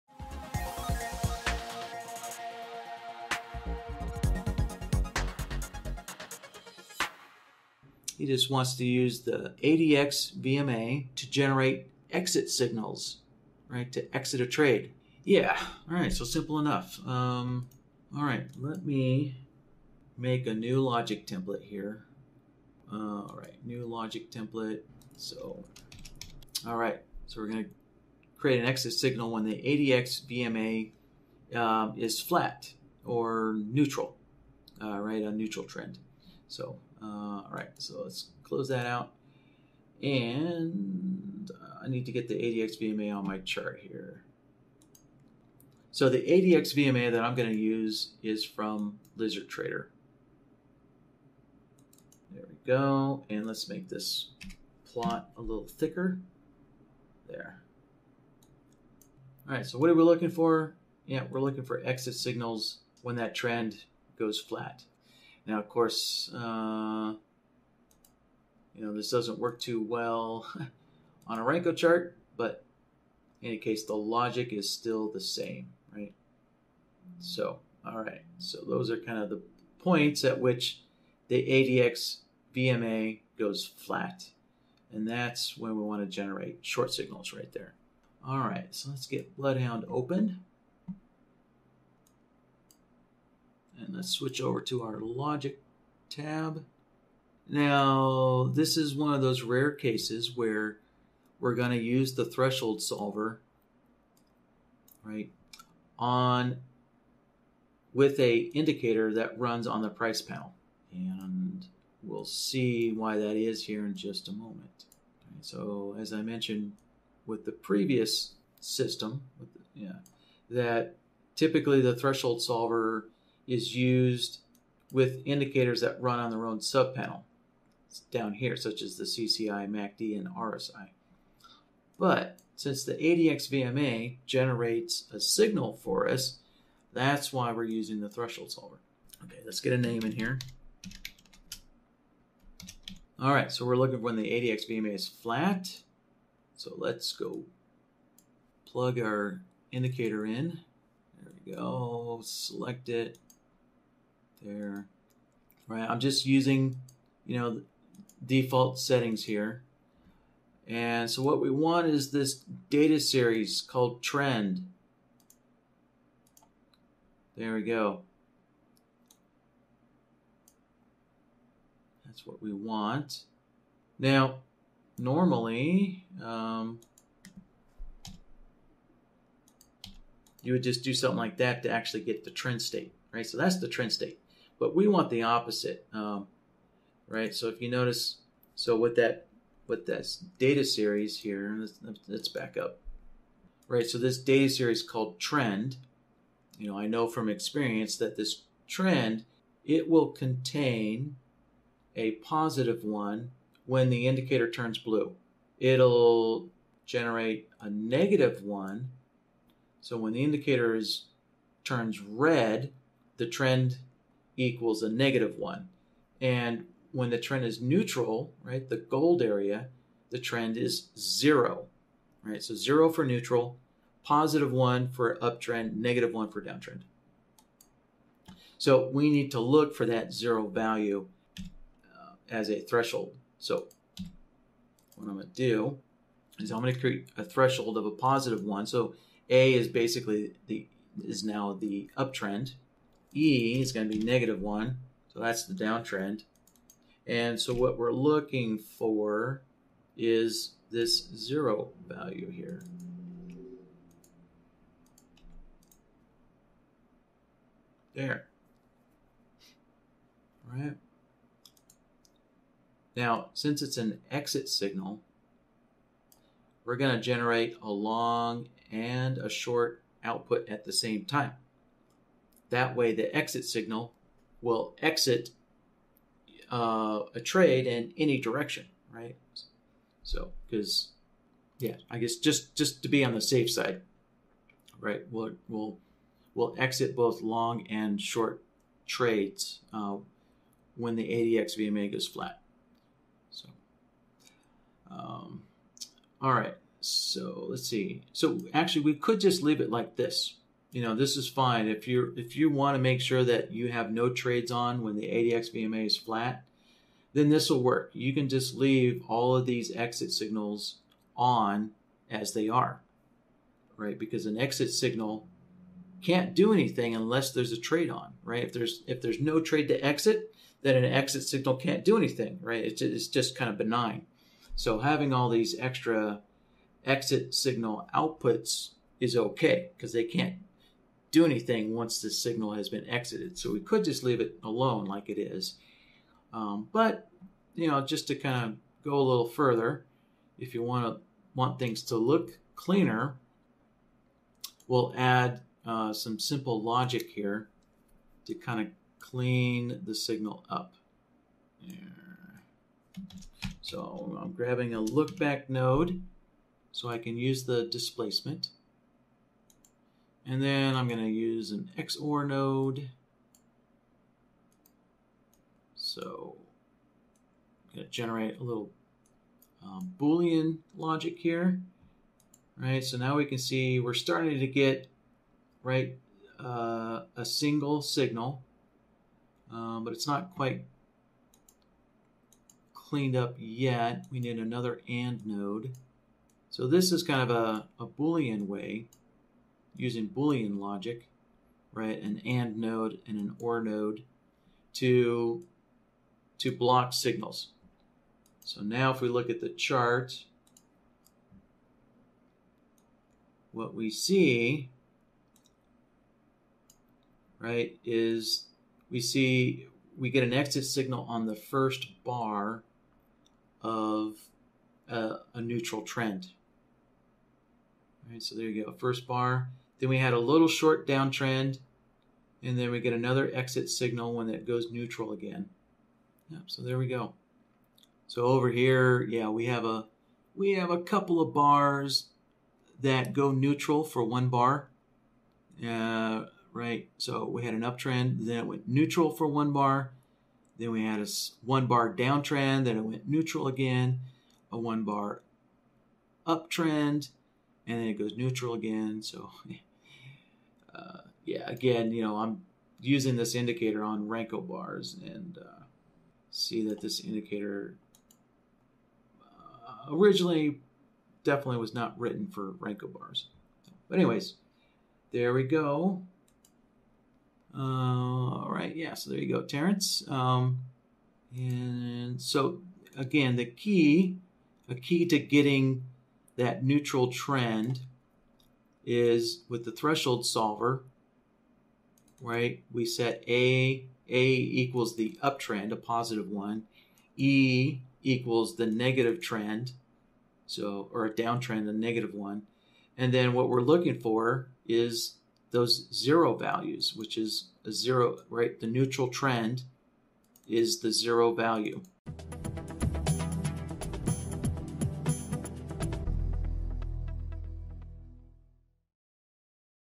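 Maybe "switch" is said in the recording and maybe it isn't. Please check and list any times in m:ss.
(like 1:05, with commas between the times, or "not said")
1:34.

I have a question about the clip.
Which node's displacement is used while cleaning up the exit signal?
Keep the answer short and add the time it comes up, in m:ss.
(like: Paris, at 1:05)
look back node, at 5:54.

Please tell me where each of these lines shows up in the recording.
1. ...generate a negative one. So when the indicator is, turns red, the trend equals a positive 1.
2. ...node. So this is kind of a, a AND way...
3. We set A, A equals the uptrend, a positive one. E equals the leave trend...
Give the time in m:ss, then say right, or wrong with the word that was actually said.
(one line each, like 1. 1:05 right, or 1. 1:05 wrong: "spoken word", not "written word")
1. 3:26 wrong: "negative", not "positive"
2. 6:25 wrong: "Boolean", not "AND"
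3. 8:02 wrong: "negative", not "leave".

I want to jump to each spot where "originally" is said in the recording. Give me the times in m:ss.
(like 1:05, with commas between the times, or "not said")
7:39.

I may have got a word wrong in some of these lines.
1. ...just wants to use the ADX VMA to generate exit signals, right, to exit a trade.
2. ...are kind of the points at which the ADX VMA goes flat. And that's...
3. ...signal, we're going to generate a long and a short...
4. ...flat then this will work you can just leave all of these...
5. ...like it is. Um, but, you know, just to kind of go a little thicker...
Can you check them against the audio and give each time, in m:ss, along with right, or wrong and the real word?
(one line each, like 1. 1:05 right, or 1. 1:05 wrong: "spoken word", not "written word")
1. 0:08 right
2. 1:18 right
3. 4:24 right
4. 5:05 right
5. 5:34 wrong: "further", not "thicker".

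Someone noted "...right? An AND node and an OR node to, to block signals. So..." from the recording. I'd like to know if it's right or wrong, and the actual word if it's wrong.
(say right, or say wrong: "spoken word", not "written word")
right.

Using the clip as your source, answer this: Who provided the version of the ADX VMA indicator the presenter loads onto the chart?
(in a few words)
Lizard Trader.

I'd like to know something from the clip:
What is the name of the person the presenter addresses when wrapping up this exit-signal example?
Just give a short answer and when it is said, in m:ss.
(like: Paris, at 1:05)
Terrence, at 7:49.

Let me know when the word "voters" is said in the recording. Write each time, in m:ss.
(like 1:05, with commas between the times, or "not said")
not said.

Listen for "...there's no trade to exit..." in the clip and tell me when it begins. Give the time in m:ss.
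5:19.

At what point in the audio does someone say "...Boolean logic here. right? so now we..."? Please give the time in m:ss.
6:09.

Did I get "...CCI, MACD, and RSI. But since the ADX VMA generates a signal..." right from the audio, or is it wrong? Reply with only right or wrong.
right.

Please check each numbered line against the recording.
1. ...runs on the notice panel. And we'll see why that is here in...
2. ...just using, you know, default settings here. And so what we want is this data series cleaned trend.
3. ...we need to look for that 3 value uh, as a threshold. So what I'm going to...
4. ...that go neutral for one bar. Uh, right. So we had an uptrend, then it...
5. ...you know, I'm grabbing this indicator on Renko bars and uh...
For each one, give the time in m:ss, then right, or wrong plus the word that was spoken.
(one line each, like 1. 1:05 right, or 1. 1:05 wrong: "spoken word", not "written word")
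1. 1:49 wrong: "price", not "notice"
2. 2:35 wrong: "called", not "cleaned"
3. 3:48 wrong: "0", not "3"
4. 7:12 right
5. 7:31 wrong: "using", not "grabbing".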